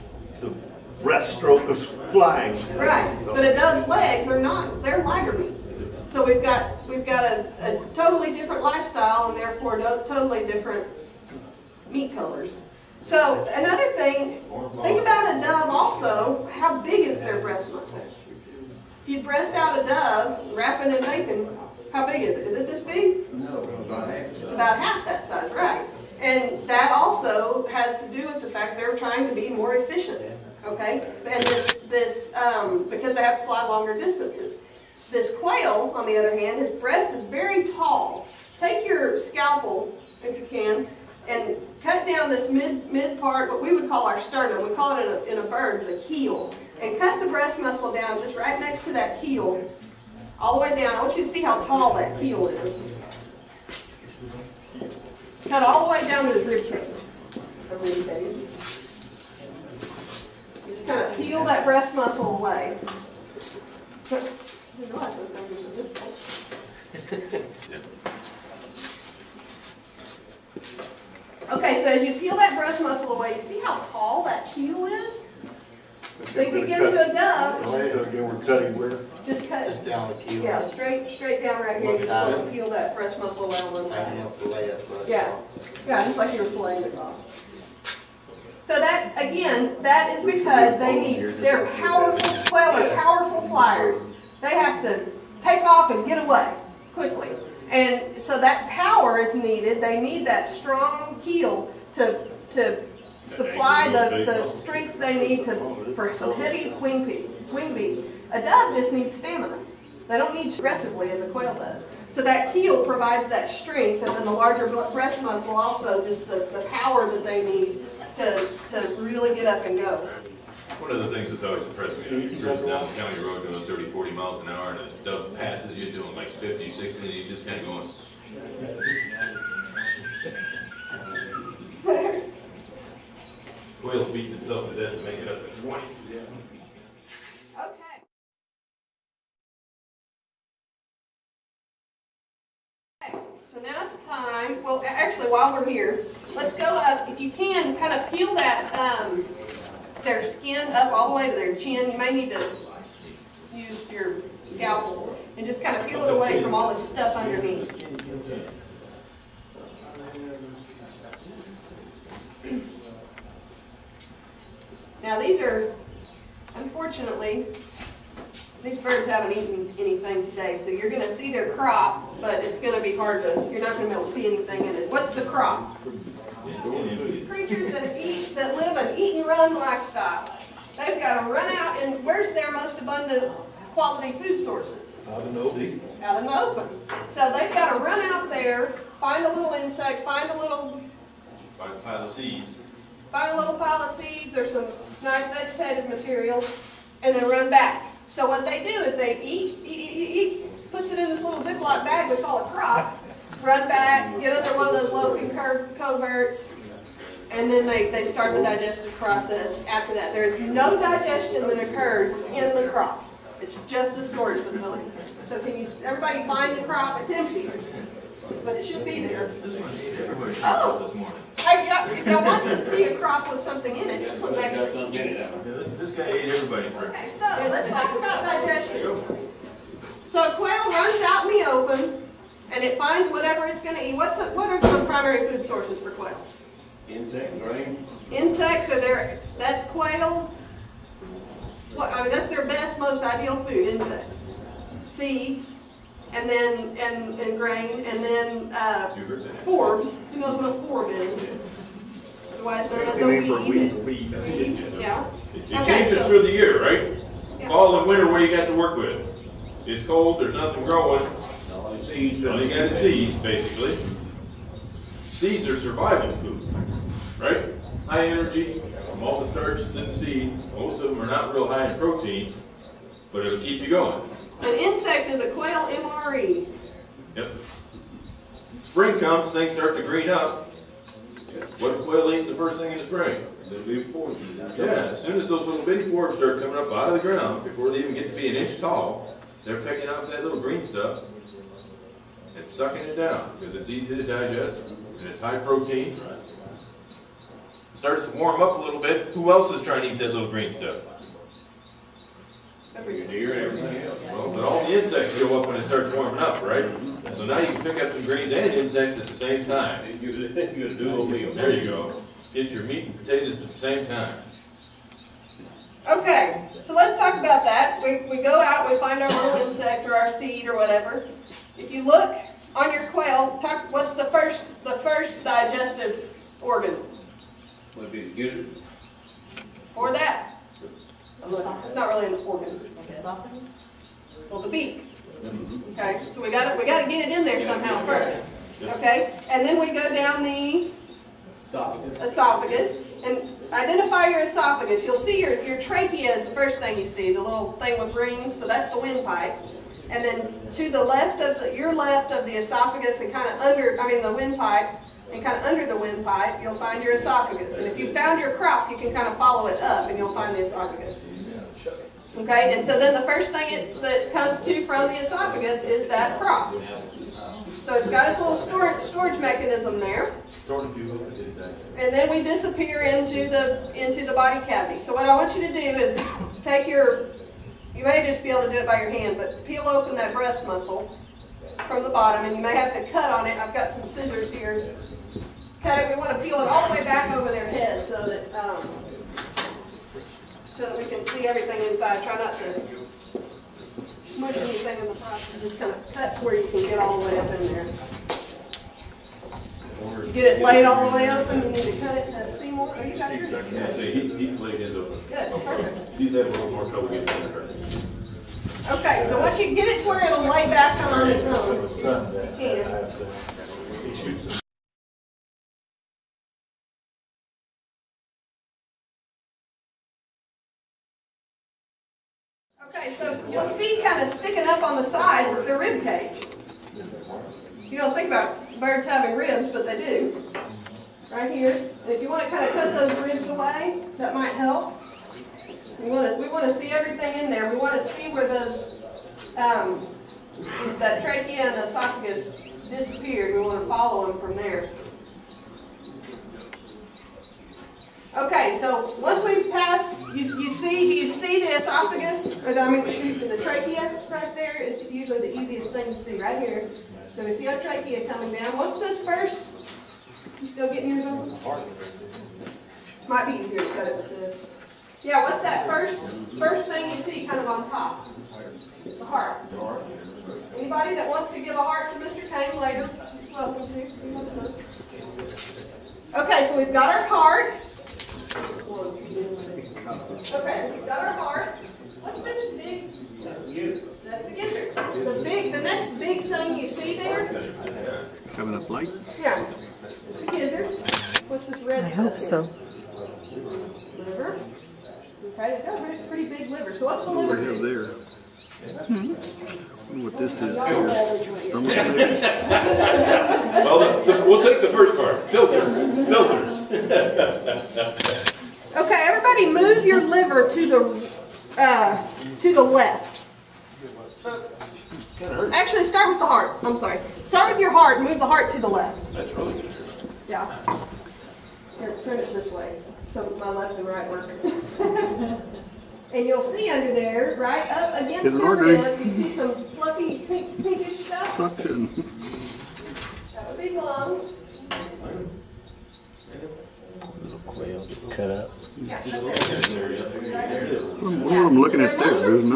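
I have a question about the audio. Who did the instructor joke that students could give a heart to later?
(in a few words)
Mr. Tang.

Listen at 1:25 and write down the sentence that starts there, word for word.
Yeah, yeah, just like you were playing it off.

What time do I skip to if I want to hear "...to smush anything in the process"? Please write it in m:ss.
6:32.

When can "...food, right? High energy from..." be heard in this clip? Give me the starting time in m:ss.
4:26.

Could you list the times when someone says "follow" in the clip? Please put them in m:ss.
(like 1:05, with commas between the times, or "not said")
5:59, 7:23.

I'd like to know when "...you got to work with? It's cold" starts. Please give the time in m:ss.
4:18.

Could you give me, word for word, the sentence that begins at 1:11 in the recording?
Okay, so as you peel that breast muscle away, you see how tall that keel is?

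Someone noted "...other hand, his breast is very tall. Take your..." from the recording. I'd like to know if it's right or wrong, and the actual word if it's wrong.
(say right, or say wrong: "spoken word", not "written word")
right.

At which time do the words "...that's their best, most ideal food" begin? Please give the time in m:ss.
4:02.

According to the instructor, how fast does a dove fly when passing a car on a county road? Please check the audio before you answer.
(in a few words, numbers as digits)
50, 60.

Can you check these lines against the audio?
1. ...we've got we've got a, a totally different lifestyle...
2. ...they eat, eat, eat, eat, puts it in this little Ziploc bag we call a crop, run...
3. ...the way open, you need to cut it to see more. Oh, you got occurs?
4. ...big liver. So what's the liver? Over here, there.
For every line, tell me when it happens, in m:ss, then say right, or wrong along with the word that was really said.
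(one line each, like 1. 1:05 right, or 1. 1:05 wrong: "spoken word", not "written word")
1. 0:06 right
2. 3:18 right
3. 6:40 wrong: "yours", not "occurs"
4. 8:16 right.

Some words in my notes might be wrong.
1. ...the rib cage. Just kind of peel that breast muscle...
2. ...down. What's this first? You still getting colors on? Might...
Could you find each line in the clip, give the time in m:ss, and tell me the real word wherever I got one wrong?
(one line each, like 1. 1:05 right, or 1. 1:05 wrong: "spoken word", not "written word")
1. 0:56 right
2. 7:38 wrong: "yours", not "colors".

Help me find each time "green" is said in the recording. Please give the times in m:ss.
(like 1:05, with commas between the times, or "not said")
4:39, 4:50, 5:00, 5:08.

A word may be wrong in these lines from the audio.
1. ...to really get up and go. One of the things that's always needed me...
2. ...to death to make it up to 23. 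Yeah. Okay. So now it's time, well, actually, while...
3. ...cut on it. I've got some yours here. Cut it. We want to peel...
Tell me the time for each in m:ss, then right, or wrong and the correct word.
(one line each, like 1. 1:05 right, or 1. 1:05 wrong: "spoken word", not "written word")
1. 1:58 wrong: "impressed", not "needed"
2. 2:14 wrong: "20", not "23"
3. 6:22 wrong: "scissors", not "yours".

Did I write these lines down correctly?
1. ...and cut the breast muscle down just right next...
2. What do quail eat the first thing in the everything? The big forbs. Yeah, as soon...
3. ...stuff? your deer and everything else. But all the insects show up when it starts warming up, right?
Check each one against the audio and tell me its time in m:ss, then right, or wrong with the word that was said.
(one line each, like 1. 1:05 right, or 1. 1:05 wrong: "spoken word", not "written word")
1. 0:46 right
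2. 4:41 wrong: "spring", not "everything"
3. 5:00 right.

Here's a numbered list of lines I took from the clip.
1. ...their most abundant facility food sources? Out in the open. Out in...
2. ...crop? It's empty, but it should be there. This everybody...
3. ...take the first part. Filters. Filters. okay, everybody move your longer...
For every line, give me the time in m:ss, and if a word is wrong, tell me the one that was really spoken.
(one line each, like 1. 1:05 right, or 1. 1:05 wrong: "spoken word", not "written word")
1. 3:02 wrong: "quality", not "facility"
2. 3:36 right
3. 8:24 wrong: "liver", not "longer".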